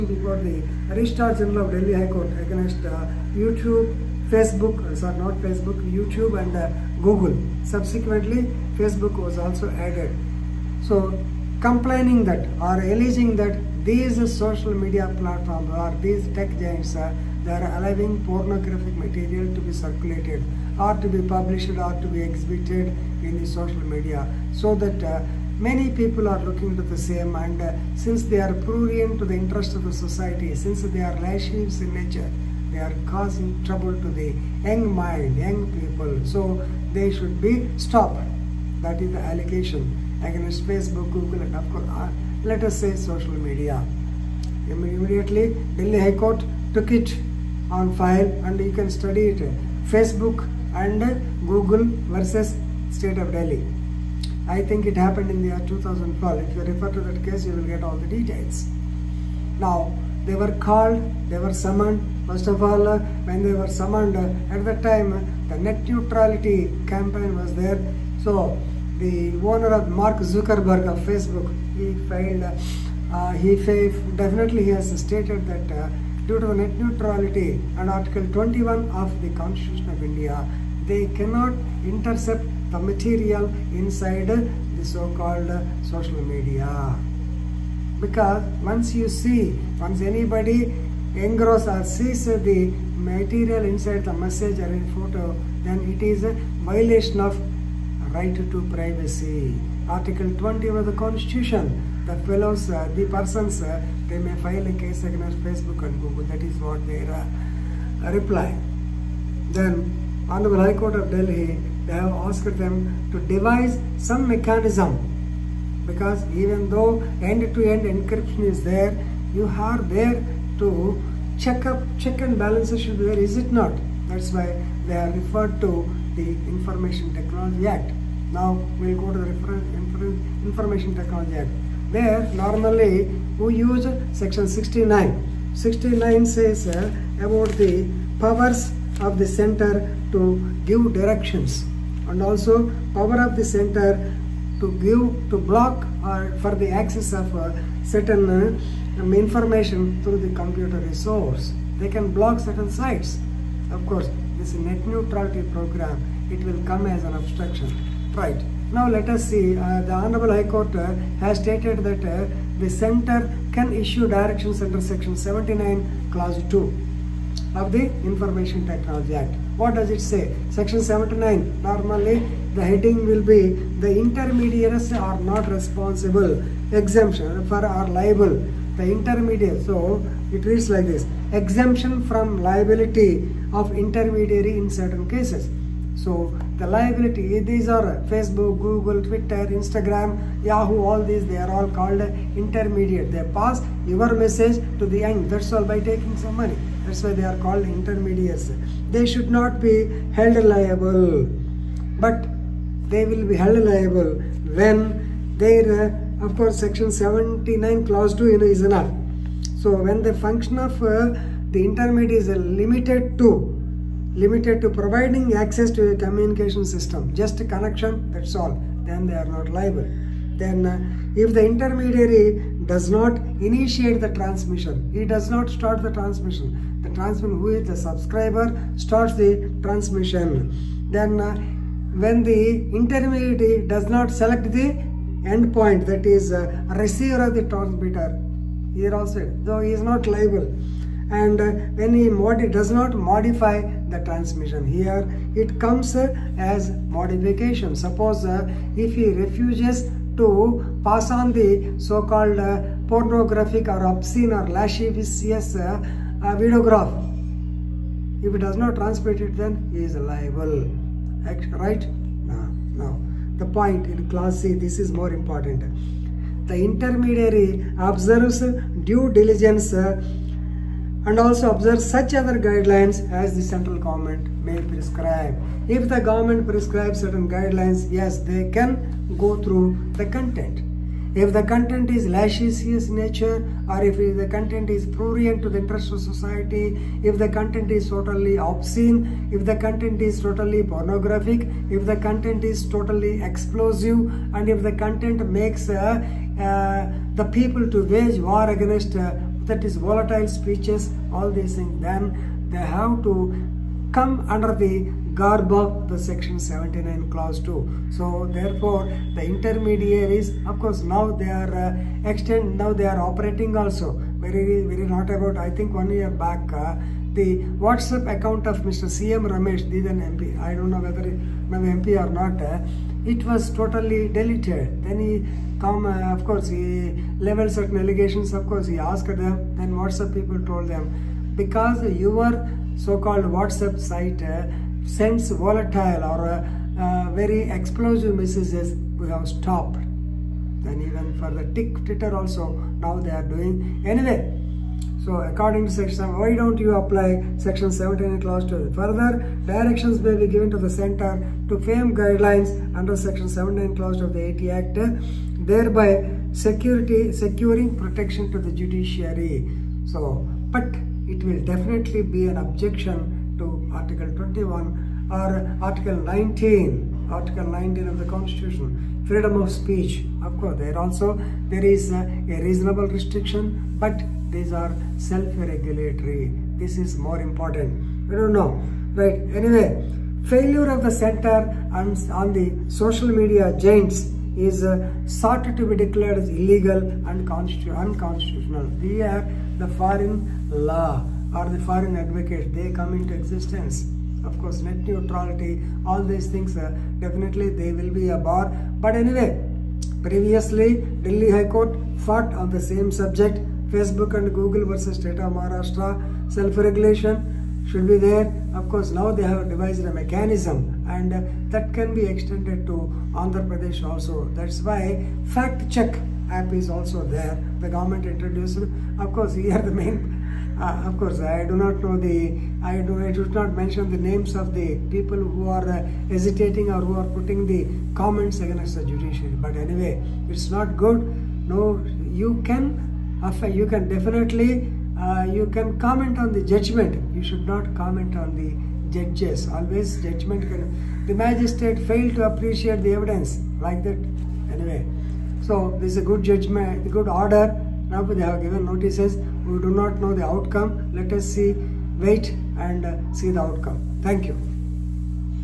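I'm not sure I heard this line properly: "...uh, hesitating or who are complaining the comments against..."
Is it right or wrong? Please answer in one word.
wrong.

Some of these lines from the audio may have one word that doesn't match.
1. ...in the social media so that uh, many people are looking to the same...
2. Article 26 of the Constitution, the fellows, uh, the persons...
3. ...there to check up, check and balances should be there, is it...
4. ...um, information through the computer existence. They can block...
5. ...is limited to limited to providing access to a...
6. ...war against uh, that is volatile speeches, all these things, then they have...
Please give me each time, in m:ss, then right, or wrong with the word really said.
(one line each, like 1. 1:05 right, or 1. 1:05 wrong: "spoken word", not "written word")
1. 0:23 right
2. 1:39 wrong: "20", not "26"
3. 1:59 right
4. 2:29 wrong: "resource", not "existence"
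5. 3:32 right
6. 4:58 right.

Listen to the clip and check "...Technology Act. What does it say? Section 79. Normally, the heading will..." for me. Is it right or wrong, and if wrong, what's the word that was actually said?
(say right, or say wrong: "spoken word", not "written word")
right.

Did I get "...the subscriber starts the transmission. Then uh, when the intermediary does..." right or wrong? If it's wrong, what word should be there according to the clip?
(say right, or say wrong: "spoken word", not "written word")
right.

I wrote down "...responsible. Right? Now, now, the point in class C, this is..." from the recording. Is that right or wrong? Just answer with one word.
wrong.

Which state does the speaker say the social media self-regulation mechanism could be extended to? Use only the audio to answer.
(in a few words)
Andhra Pradesh.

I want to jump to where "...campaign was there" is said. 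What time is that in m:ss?
1:06.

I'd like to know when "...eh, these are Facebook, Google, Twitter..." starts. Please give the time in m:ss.
3:07.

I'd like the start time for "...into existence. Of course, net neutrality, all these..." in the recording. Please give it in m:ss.
6:32.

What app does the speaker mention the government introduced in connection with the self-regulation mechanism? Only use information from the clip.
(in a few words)
Fact check app.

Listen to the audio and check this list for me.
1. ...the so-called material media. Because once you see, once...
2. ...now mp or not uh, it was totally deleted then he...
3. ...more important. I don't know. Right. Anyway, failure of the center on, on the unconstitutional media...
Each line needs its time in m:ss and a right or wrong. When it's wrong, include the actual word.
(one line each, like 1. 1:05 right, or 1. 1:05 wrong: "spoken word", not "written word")
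1. 1:24 wrong: "social", not "material"
2. 5:21 right
3. 6:16 wrong: "social", not "unconstitutional".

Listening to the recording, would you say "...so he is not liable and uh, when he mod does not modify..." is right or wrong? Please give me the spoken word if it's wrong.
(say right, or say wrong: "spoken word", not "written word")
right.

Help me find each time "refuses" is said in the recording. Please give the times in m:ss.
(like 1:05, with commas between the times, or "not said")
4:09.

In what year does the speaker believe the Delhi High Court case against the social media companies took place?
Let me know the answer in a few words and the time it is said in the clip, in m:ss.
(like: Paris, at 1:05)
2012, at 0:55.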